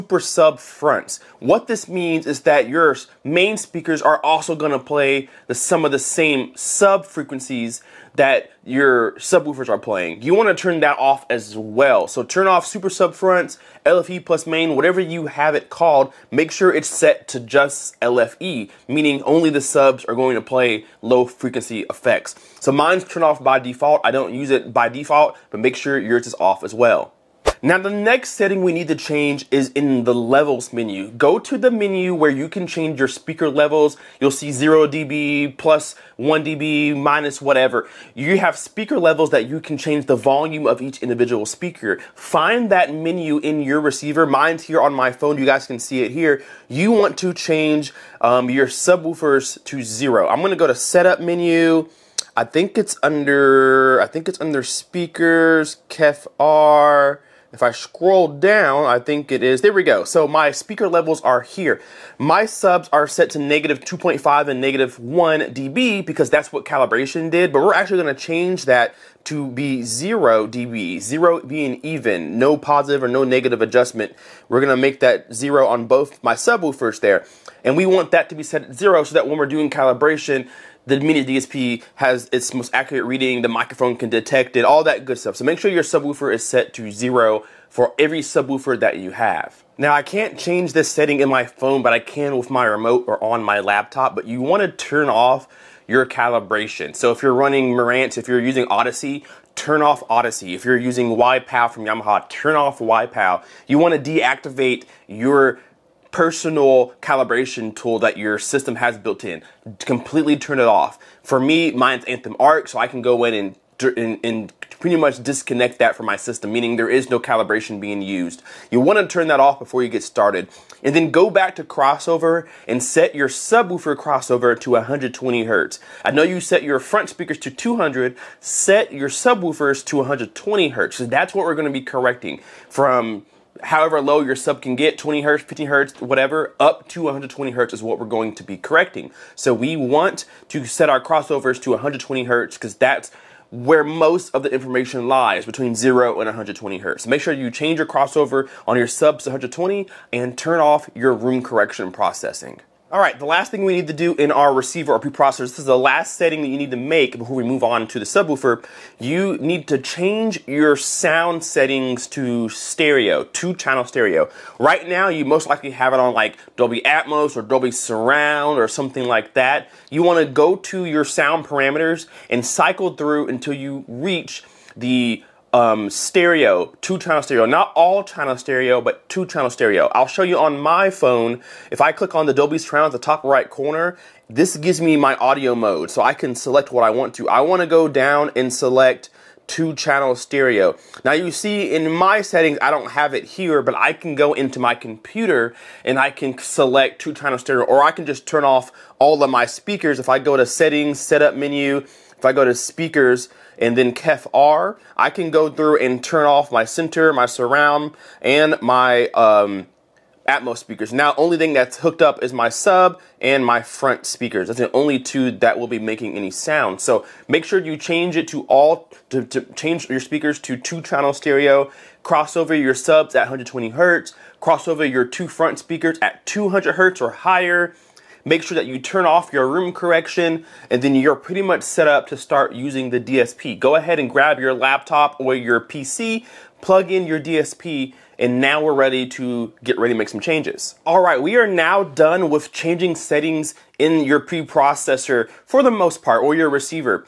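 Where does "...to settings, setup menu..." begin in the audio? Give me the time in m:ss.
3:20.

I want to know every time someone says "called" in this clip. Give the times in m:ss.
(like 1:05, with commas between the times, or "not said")
0:15.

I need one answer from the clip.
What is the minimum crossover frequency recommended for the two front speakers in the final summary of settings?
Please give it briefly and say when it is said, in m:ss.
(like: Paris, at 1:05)
200 Hz, at 3:46.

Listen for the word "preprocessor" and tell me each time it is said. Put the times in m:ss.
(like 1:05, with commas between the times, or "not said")
2:35, 4:04.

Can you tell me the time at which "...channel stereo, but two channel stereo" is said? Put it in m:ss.
2:58.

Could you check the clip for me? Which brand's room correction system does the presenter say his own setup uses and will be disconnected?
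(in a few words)
Anthem Arc.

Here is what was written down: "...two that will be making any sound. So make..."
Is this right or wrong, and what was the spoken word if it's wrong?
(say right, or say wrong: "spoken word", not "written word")
right.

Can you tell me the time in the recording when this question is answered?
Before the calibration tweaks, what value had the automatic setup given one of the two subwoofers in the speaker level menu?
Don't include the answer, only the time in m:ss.
1:03.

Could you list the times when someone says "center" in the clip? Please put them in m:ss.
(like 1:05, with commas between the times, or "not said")
3:26.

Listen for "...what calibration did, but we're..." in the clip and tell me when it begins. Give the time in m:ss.
1:06.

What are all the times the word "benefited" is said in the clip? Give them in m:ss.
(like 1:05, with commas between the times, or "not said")
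not said.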